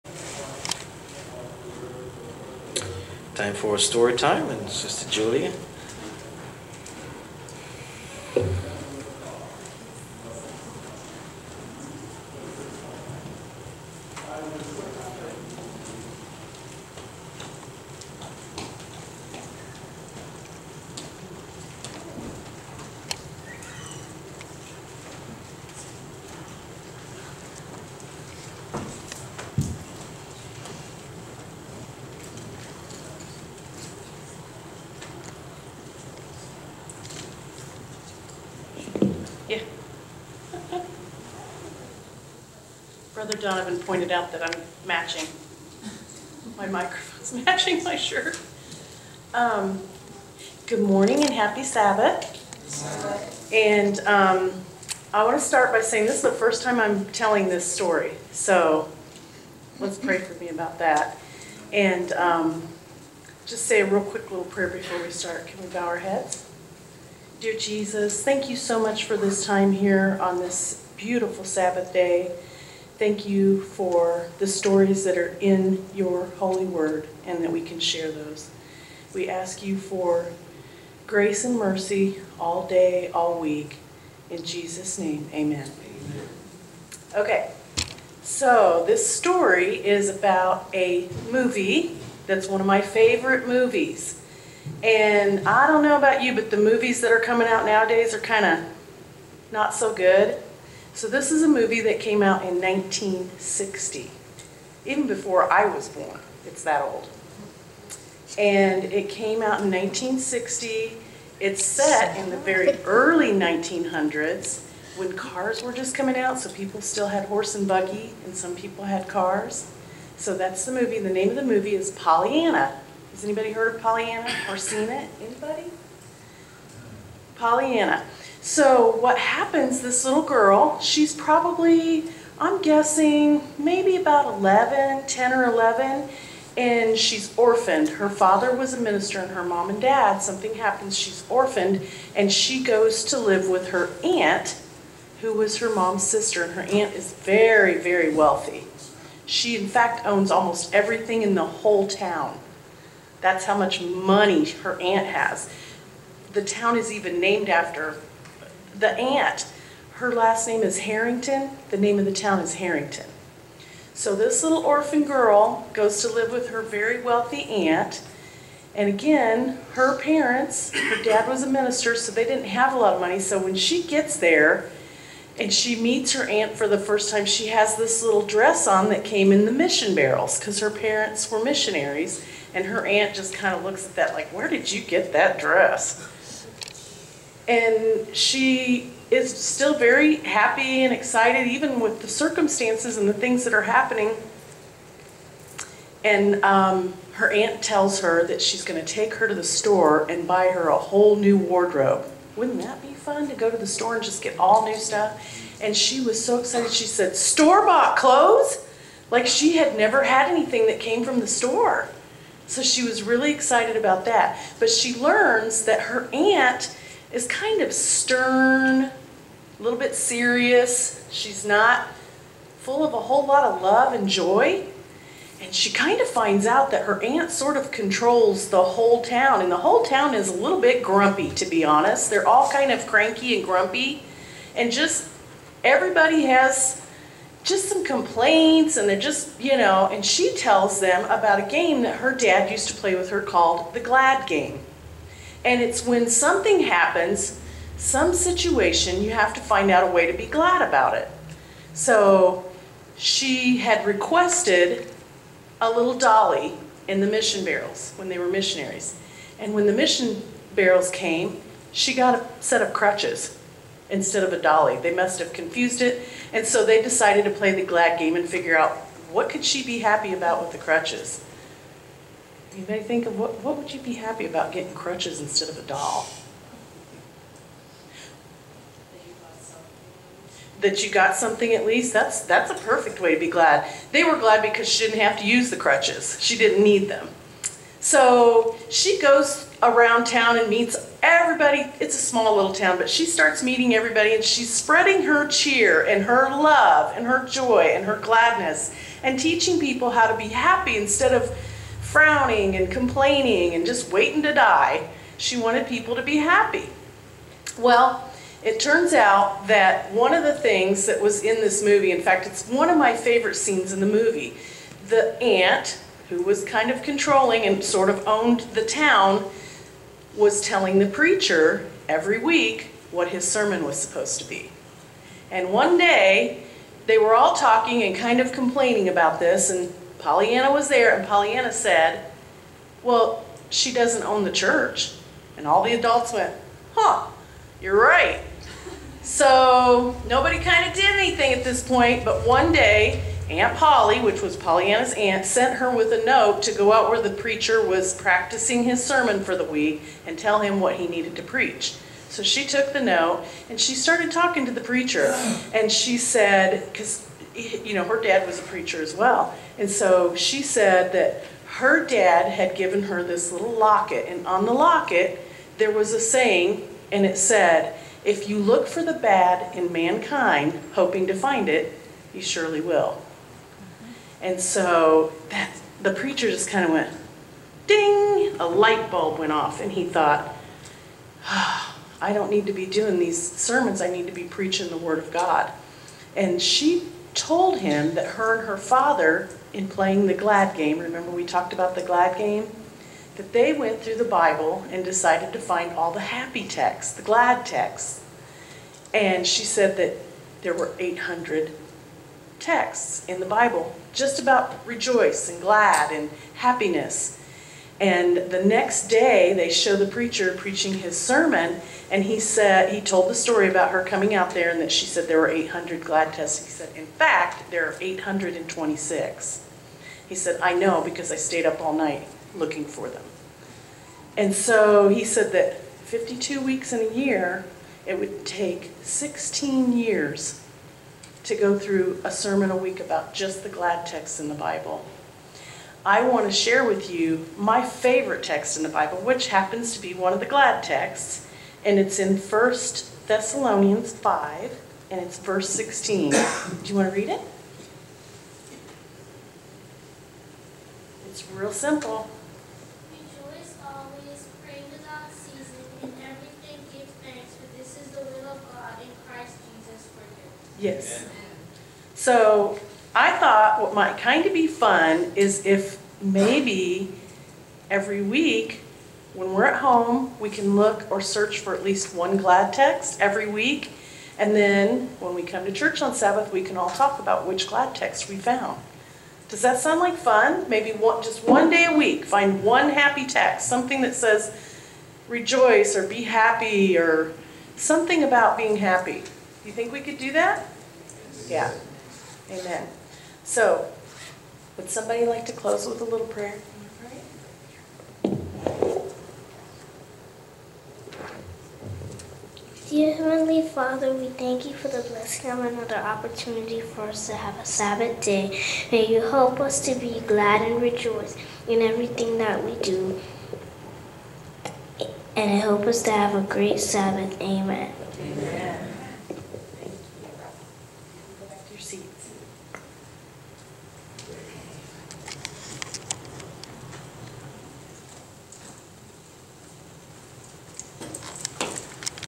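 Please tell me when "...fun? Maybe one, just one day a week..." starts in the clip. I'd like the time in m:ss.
7:59.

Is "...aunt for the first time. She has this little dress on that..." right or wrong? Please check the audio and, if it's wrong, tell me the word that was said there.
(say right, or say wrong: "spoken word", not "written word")
right.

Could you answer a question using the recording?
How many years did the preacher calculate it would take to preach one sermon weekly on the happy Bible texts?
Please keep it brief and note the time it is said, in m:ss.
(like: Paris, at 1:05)
16, at 7:08.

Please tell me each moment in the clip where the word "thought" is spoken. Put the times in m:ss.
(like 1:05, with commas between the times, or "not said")
6:19, 7:43.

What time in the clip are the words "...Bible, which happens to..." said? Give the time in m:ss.
7:18.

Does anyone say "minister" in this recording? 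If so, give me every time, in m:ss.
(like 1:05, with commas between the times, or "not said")
2:18, 2:51.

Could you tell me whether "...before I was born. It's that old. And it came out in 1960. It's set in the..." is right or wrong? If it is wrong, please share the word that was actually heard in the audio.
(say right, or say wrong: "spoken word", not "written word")
right.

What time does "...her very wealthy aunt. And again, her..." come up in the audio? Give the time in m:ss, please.
2:46.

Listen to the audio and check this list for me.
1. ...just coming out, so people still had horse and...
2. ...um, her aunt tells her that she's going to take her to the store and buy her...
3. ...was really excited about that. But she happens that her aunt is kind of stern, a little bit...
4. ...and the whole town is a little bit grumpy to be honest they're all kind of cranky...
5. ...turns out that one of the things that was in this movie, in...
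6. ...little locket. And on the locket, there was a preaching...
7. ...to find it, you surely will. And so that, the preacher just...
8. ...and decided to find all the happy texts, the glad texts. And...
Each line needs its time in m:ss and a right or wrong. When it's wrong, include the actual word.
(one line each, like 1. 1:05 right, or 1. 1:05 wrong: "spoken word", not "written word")
1. 1:55 right
2. 3:16 right
3. 3:32 wrong: "learns", not "happens"
4. 3:49 right
5. 5:08 right
6. 6:03 wrong: "saying", not "preaching"
7. 6:11 right
8. 6:34 right.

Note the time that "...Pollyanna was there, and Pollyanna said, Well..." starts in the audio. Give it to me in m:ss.
5:29.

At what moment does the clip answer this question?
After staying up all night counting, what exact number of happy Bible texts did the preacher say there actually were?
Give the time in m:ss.
6:57.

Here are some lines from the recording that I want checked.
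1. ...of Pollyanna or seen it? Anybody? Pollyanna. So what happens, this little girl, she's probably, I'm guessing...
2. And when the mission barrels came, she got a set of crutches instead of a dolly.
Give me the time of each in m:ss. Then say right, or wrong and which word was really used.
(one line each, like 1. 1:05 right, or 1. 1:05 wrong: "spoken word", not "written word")
1. 2:03 right
2. 4:19 right.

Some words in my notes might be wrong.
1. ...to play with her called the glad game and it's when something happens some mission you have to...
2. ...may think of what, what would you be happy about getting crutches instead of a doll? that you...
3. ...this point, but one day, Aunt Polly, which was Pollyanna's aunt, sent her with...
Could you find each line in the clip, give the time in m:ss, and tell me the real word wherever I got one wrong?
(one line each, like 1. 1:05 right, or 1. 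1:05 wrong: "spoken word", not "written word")
1. 4:02 wrong: "situation", not "mission"
2. 4:32 right
3. 5:41 right.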